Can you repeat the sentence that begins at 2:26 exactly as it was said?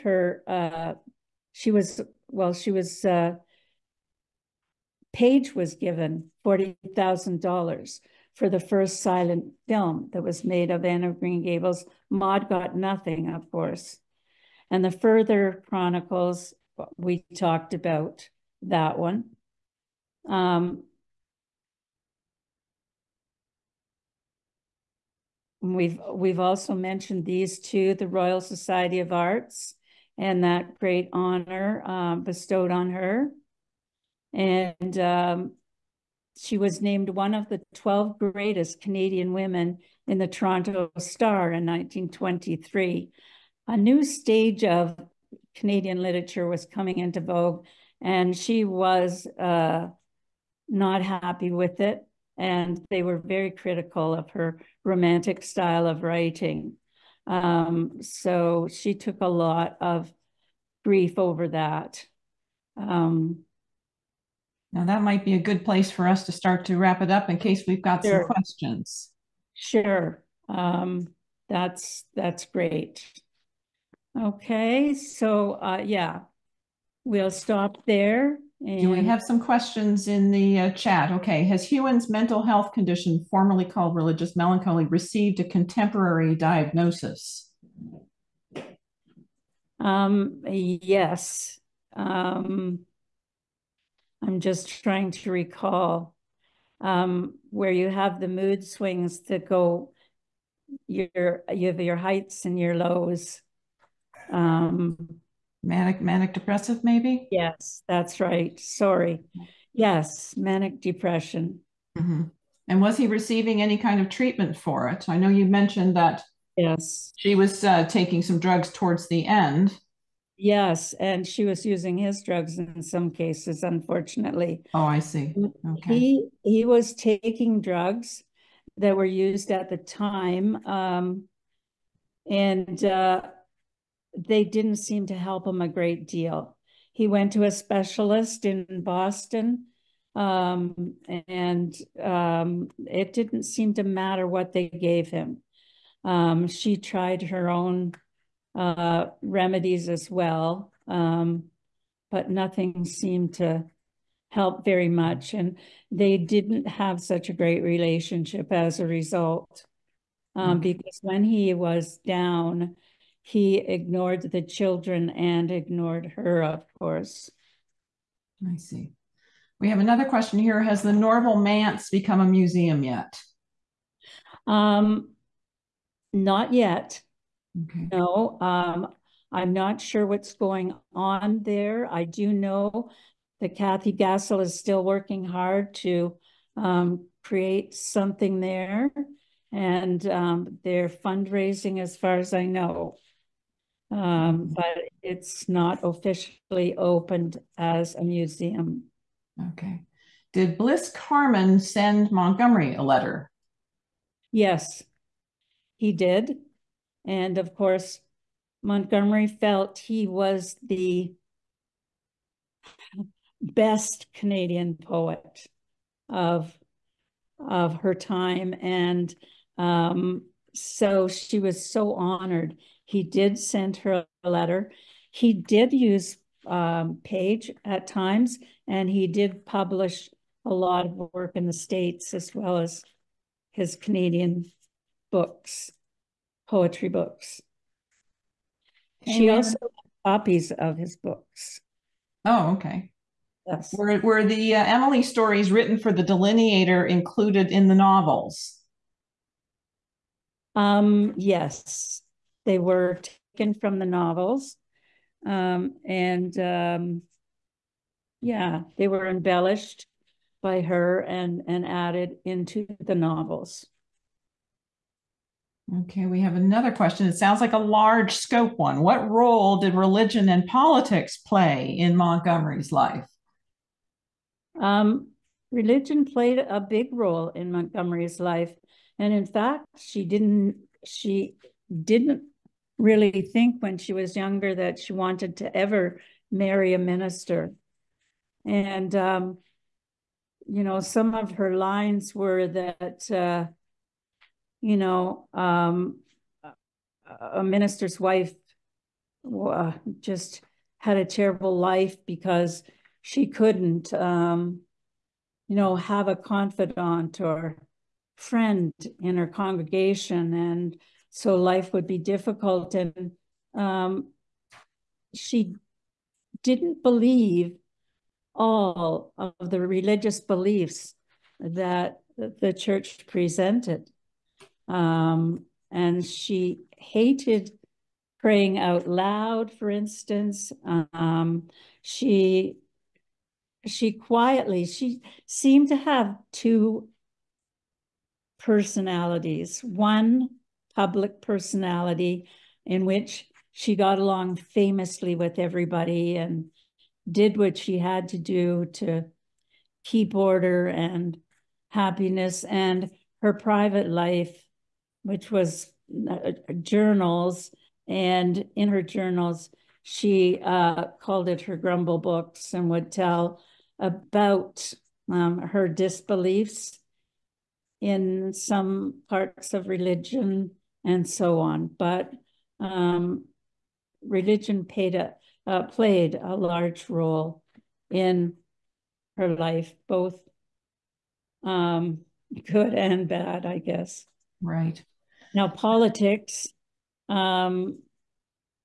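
Um, she tried her own uh, remedies as well, um, but nothing seemed to help very much.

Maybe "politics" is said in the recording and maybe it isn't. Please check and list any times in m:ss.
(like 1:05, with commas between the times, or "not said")
4:30, 6:25.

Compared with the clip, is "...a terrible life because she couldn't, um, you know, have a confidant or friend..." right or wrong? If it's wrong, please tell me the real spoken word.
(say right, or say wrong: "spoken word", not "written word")
right.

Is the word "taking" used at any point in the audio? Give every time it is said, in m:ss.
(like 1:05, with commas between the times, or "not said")
1:57, 2:06.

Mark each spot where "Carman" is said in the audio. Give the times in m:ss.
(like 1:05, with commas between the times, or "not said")
3:20.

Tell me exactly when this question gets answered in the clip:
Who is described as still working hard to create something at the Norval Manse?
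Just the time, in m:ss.
3:03.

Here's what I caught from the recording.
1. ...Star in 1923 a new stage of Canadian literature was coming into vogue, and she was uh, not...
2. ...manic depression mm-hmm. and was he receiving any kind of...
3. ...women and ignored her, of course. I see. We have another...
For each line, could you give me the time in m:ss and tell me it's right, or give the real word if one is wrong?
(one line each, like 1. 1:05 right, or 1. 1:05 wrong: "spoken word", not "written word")
1. 0:40 right
2. 1:50 right
3. 2:44 wrong: "children", not "women".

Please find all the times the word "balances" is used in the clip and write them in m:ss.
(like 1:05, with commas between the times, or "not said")
not said.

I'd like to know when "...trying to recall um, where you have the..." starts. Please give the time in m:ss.
1:34.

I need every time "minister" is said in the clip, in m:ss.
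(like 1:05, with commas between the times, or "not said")
4:46, 4:57.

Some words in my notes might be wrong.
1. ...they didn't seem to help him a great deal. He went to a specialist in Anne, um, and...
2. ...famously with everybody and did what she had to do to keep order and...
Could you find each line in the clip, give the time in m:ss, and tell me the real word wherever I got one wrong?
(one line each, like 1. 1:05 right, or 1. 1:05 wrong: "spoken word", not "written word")
1. 2:14 wrong: "Boston", not "Anne"
2. 5:44 right.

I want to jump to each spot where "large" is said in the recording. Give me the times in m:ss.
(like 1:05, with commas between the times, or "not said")
4:27, 6:16.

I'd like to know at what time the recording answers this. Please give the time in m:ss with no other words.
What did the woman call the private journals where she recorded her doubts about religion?
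6:01.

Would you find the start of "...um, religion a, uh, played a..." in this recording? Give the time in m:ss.
6:12.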